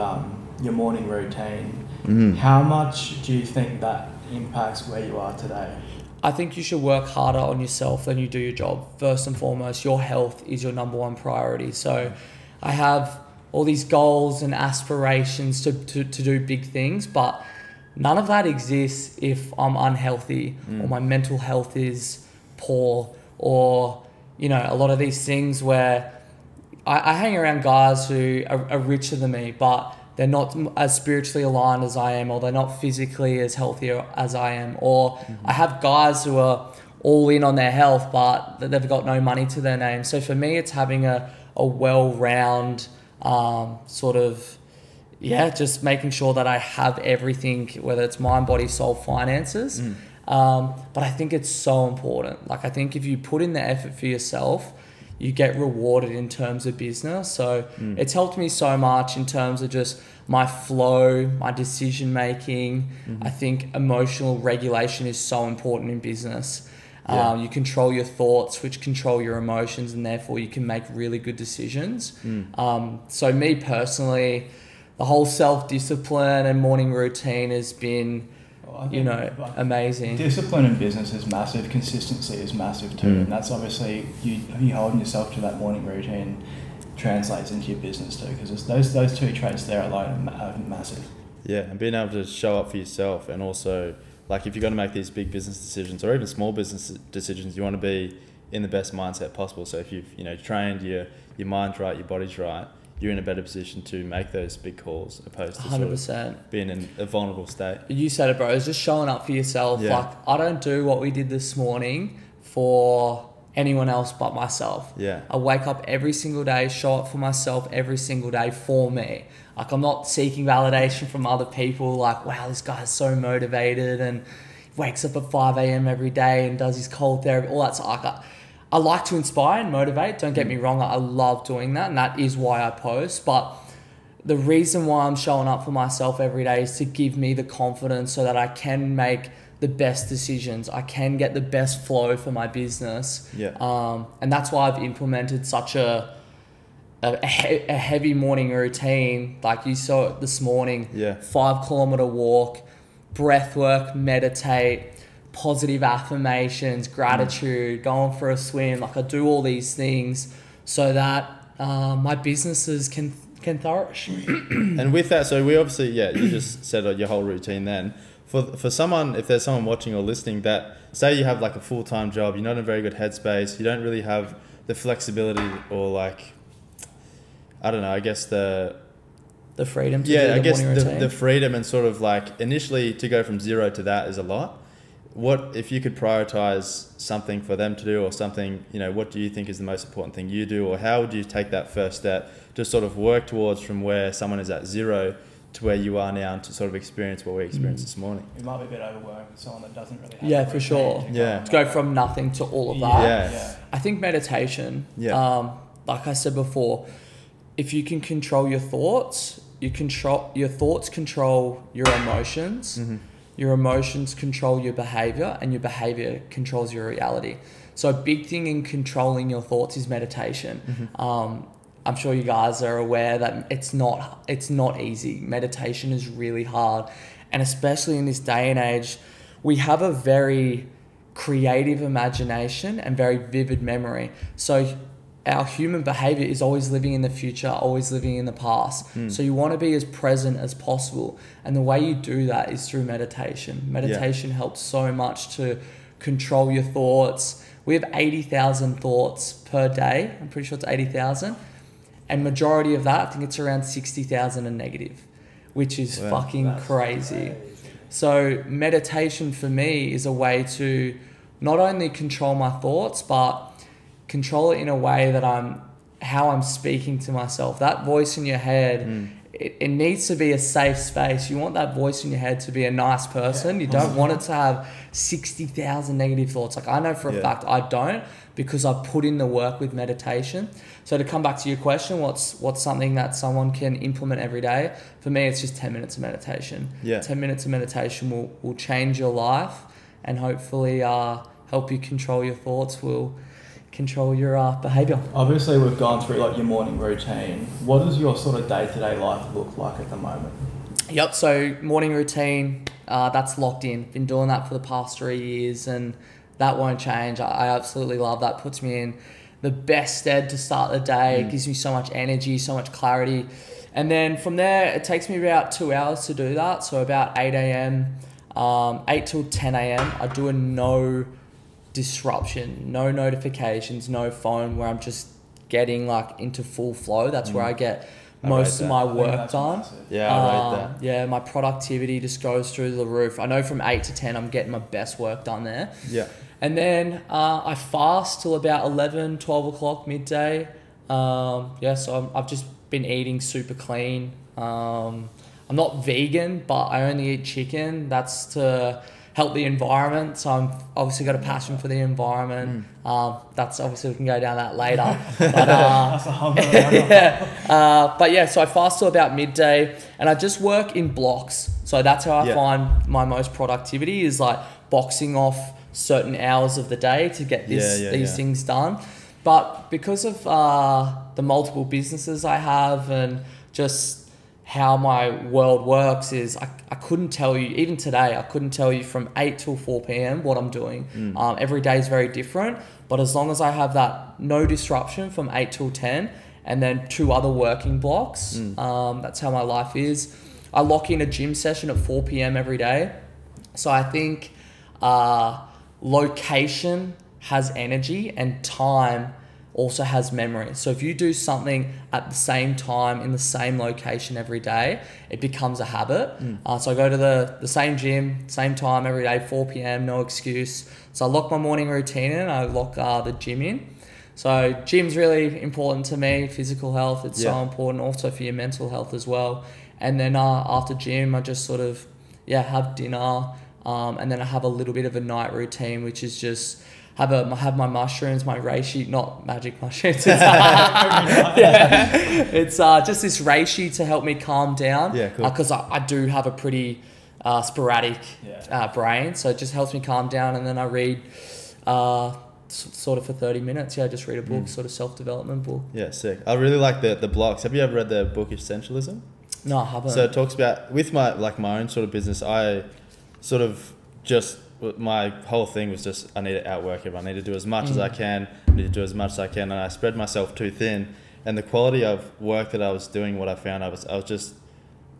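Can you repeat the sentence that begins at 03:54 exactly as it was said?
So our human behavior is always living in the future, always living in the past.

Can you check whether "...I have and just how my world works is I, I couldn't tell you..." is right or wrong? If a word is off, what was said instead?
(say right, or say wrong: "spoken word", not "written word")
right.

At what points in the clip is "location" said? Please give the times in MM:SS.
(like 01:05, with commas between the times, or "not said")
06:35, 06:43.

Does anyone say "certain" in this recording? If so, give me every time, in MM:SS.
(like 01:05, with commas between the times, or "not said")
06:05.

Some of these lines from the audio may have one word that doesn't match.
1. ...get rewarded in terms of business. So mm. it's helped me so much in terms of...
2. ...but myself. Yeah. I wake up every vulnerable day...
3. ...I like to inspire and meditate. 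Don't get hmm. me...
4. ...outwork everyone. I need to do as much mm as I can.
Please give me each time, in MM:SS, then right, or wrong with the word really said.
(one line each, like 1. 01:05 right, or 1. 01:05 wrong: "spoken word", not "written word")
1. 00:55 right
2. 01:54 wrong: "single", not "vulnerable"
3. 02:08 wrong: "motivate", not "meditate"
4. 07:36 right.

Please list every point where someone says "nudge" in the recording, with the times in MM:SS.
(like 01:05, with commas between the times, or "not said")
not said.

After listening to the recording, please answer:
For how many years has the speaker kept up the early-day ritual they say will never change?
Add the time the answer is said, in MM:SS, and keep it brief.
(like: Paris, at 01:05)
3 years, at 05:04.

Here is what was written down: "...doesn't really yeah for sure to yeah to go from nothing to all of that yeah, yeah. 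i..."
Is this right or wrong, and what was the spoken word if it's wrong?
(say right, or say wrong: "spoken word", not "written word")
right.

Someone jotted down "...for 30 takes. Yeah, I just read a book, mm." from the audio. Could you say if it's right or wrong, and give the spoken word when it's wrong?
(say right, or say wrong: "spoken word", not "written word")
wrong: "minutes", not "takes".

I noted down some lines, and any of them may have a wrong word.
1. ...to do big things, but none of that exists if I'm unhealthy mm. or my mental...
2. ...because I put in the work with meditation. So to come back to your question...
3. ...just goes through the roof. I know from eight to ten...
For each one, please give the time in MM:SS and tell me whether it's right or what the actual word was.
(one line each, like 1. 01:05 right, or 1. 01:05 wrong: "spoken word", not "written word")
1. 00:16 right
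2. 04:38 right
3. 05:31 right.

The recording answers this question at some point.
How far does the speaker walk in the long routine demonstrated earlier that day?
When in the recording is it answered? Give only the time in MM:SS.
02:31.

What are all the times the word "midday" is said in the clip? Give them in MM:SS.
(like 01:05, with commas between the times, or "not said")
05:39, 05:59.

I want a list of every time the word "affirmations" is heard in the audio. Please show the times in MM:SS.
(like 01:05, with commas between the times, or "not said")
02:35.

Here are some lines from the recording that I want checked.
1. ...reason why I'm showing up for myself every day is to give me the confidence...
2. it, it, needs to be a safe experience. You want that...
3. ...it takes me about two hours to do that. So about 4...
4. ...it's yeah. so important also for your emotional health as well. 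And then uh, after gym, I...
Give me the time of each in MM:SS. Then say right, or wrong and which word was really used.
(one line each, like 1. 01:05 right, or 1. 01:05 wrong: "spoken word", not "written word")
1. 02:14 right
2. 04:29 wrong: "space", not "experience"
3. 05:14 wrong: "8", not "4"
4. 06:57 wrong: "mental", not "emotional".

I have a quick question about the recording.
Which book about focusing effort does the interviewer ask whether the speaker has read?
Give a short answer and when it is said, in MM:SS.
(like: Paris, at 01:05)
Essentialism, at 07:28.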